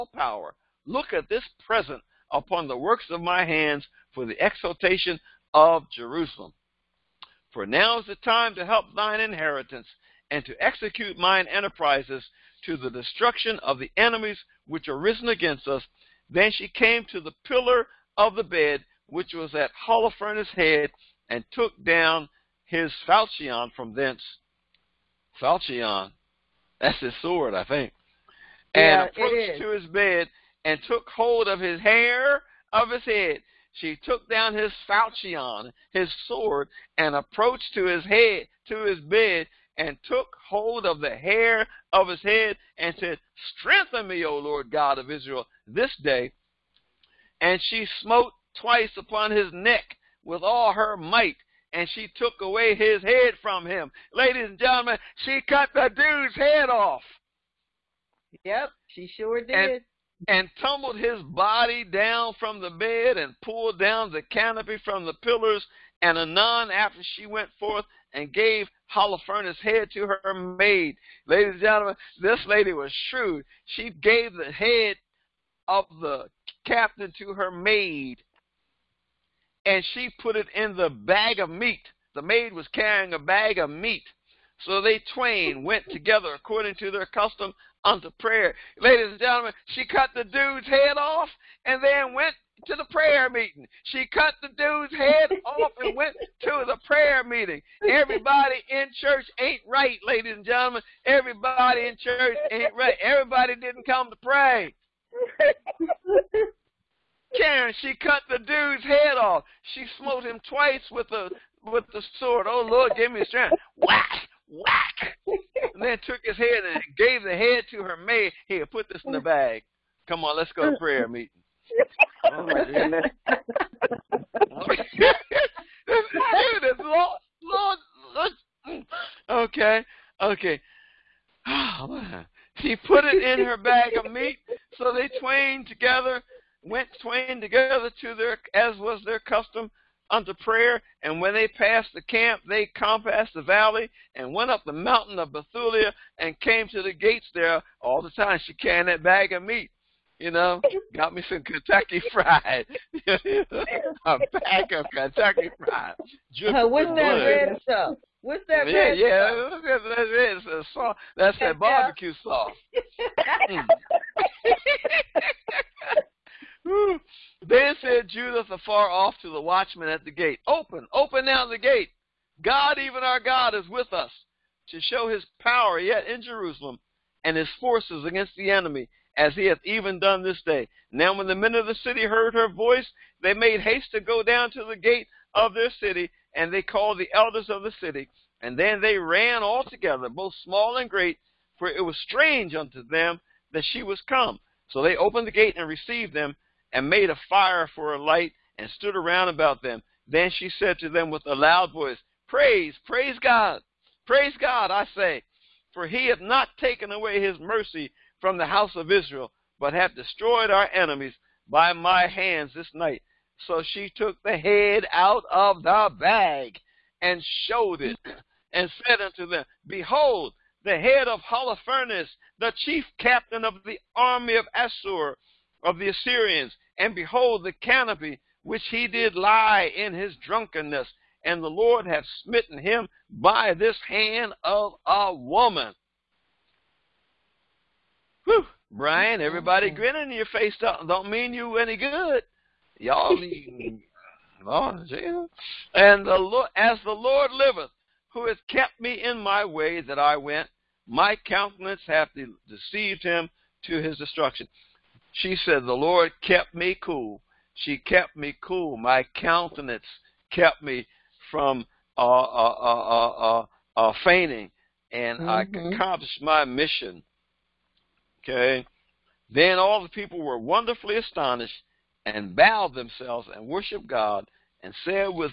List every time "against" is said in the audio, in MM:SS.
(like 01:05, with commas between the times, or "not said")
00:15, 02:58.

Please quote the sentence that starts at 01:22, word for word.
The maid was carrying a bag of meat.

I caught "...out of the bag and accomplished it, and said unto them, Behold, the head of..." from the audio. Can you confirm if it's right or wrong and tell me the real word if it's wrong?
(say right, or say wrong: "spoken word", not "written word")
wrong: "showed", not "accomplished".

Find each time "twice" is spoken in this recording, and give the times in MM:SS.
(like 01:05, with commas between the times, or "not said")
00:48, 01:50.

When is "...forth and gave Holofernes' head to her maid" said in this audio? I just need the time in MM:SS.
01:07.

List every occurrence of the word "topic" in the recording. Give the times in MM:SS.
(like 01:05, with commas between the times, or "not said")
not said.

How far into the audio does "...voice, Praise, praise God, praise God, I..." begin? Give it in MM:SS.
03:21.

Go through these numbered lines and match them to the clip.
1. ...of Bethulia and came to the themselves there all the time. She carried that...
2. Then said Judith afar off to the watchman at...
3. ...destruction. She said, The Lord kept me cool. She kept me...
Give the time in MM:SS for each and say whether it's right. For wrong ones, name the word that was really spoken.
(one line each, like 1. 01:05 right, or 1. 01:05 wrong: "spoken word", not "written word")
1. 02:25 wrong: "gates", not "themselves"
2. 02:47 right
3. 04:13 right.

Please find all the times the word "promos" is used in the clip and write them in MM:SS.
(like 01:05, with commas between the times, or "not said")
not said.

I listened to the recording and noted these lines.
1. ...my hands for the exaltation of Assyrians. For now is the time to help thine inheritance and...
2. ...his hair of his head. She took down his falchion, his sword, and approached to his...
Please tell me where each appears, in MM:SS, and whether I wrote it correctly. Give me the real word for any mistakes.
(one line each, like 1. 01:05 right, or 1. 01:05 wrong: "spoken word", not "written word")
1. 00:03 wrong: "Jerusalem", not "Assyrians"
2. 00:31 right.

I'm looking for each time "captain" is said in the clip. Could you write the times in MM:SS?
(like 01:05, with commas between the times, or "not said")
01:16, 03:42.